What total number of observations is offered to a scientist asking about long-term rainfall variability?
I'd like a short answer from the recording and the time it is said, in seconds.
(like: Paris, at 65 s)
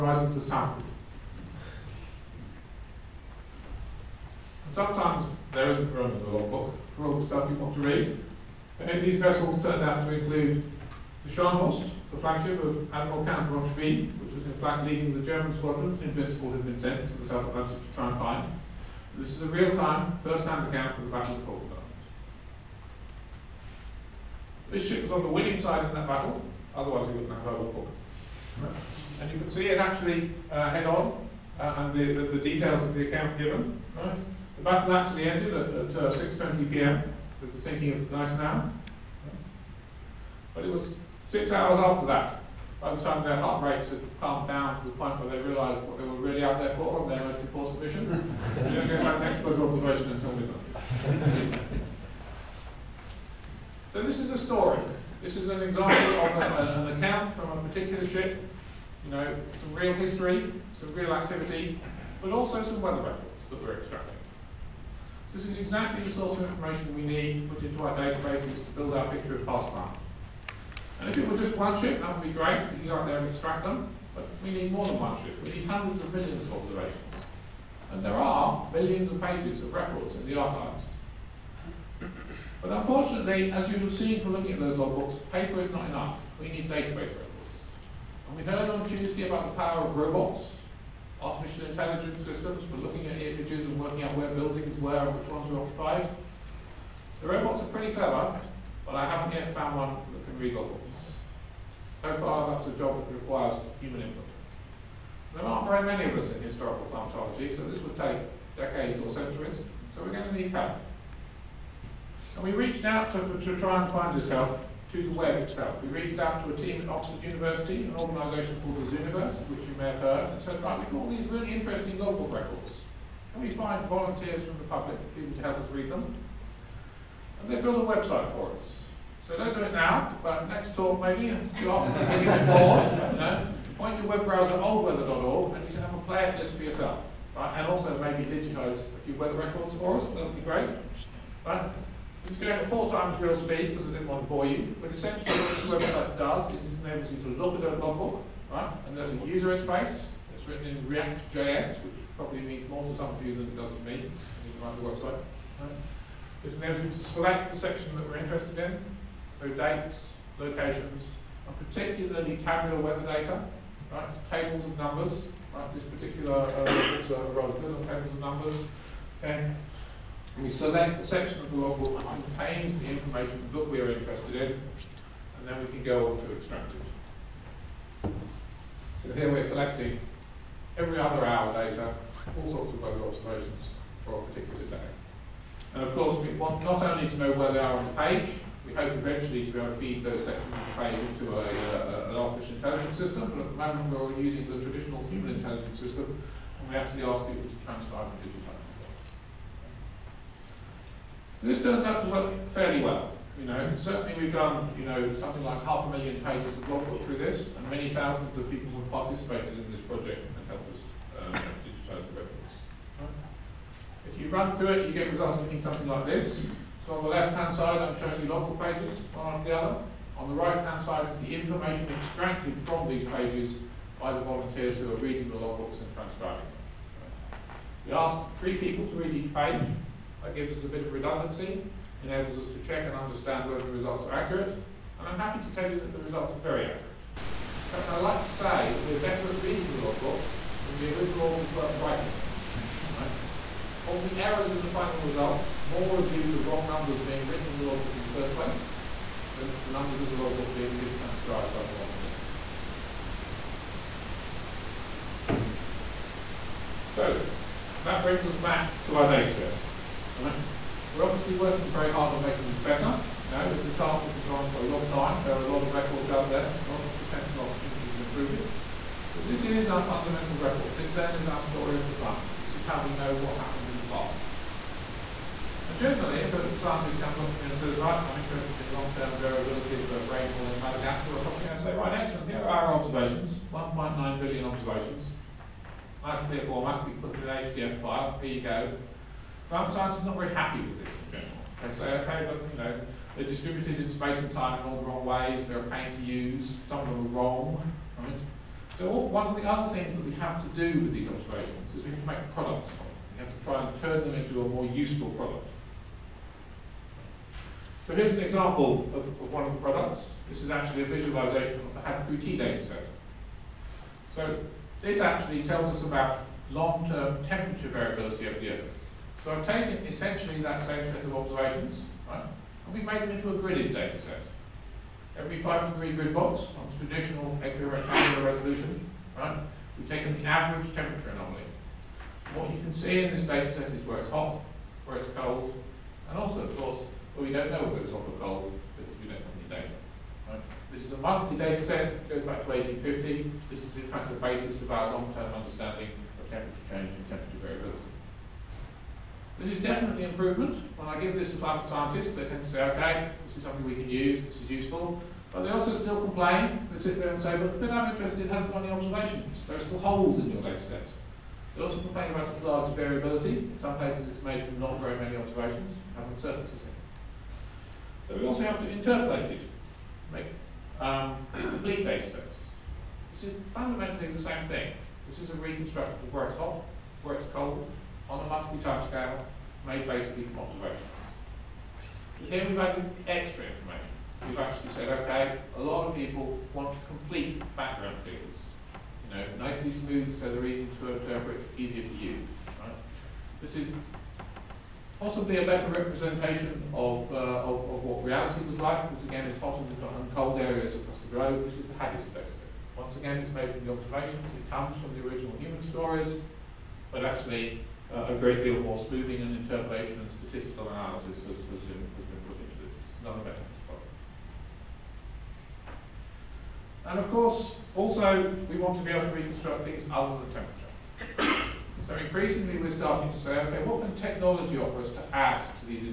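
1.9 billion, at 283 s.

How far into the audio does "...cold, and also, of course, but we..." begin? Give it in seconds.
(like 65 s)
335 s.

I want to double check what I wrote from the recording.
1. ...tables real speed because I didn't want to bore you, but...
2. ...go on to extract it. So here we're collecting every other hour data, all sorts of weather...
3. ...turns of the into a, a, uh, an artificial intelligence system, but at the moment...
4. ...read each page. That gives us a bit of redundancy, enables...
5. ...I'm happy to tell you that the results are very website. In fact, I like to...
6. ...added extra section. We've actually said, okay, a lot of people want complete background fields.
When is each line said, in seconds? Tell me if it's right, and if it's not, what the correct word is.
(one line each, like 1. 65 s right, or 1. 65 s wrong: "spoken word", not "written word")
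1. 142 s wrong: "times", not "tables"
2. 175 s right
3. 190 s wrong: "sections", not "turns"
4. 228 s right
5. 235 s wrong: "accurate", not "website"
6. 382 s wrong: "information", not "section".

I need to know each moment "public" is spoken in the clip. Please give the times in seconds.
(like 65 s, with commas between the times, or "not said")
124 s.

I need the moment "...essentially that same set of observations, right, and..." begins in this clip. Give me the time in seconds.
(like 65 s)
319 s.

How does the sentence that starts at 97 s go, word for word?
The robots are pretty clever, but I haven't yet found one that can read logbooks.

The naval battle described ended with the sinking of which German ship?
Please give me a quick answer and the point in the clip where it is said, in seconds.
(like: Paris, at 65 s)
Gneisenau, at 38 s.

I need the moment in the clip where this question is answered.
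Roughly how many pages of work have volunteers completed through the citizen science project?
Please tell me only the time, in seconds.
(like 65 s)
205 s.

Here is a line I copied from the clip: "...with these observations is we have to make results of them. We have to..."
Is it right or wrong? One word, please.
wrong.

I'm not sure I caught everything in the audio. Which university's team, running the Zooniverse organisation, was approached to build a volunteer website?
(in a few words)
Oxford University.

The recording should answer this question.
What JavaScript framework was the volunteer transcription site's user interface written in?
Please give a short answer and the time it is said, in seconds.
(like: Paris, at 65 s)
React.js, at 150 s.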